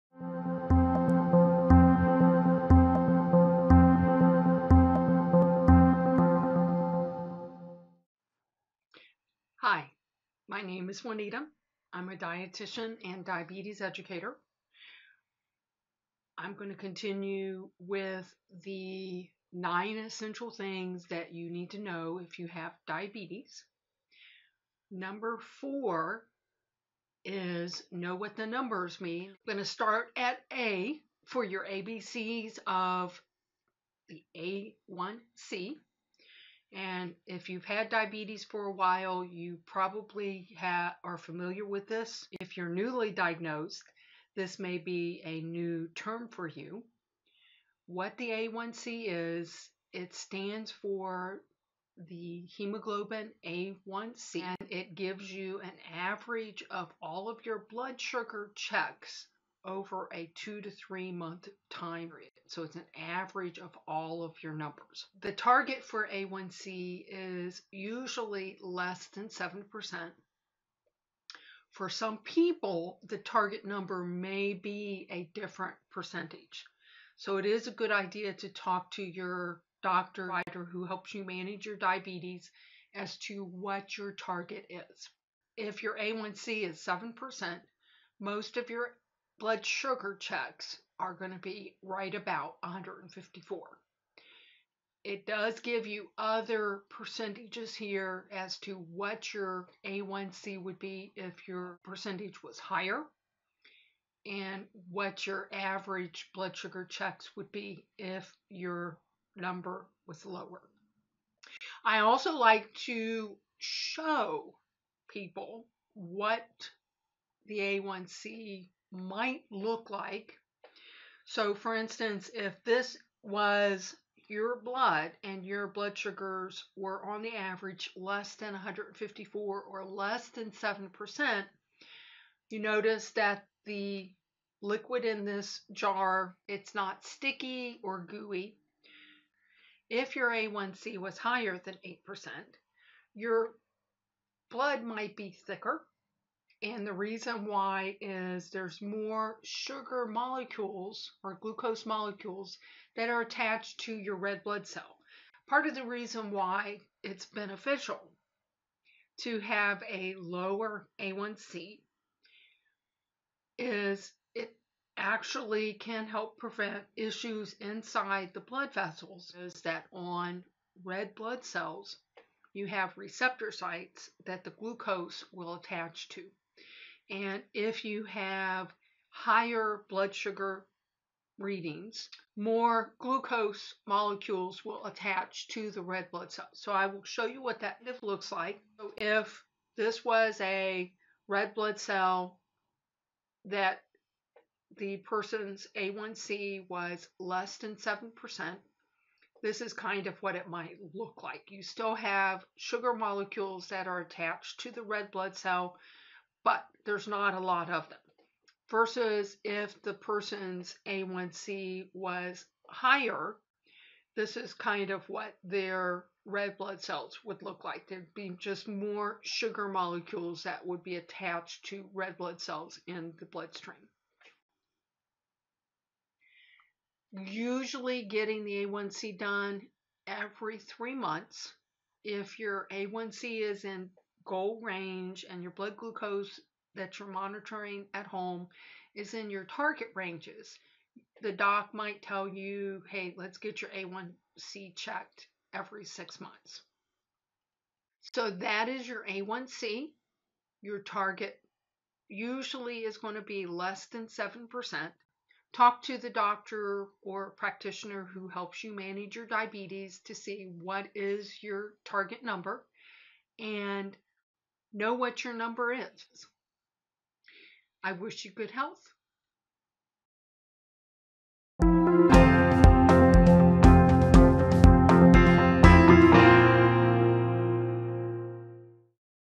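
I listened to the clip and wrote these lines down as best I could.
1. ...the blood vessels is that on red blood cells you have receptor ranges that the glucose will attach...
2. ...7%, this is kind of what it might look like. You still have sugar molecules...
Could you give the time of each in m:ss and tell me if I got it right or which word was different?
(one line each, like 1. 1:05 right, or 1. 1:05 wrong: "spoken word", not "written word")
1. 2:48 wrong: "sites", not "ranges"
2. 3:17 right.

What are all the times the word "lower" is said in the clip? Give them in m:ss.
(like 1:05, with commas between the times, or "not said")
1:50, 2:40.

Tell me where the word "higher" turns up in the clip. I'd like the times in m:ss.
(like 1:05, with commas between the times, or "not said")
1:42, 2:21, 2:59, 3:32.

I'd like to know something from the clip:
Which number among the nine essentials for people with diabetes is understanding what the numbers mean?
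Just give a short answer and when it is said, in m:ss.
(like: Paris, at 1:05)
4, at 0:25.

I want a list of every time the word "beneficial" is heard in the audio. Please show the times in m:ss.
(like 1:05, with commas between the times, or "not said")
2:37.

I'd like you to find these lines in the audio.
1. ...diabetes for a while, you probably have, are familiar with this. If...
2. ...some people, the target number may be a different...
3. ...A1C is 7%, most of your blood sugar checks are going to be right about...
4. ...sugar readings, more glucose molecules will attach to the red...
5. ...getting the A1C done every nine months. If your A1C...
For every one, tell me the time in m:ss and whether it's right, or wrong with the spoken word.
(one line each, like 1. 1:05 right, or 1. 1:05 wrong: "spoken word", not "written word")
1. 0:37 right
2. 1:11 right
3. 1:25 right
4. 3:00 right
5. 3:48 wrong: "three", not "nine".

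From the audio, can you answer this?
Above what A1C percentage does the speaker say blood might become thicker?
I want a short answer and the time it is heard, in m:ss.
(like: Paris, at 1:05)
8%, at 2:21.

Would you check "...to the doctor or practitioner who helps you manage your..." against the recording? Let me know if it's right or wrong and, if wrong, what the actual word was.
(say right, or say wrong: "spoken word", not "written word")
right.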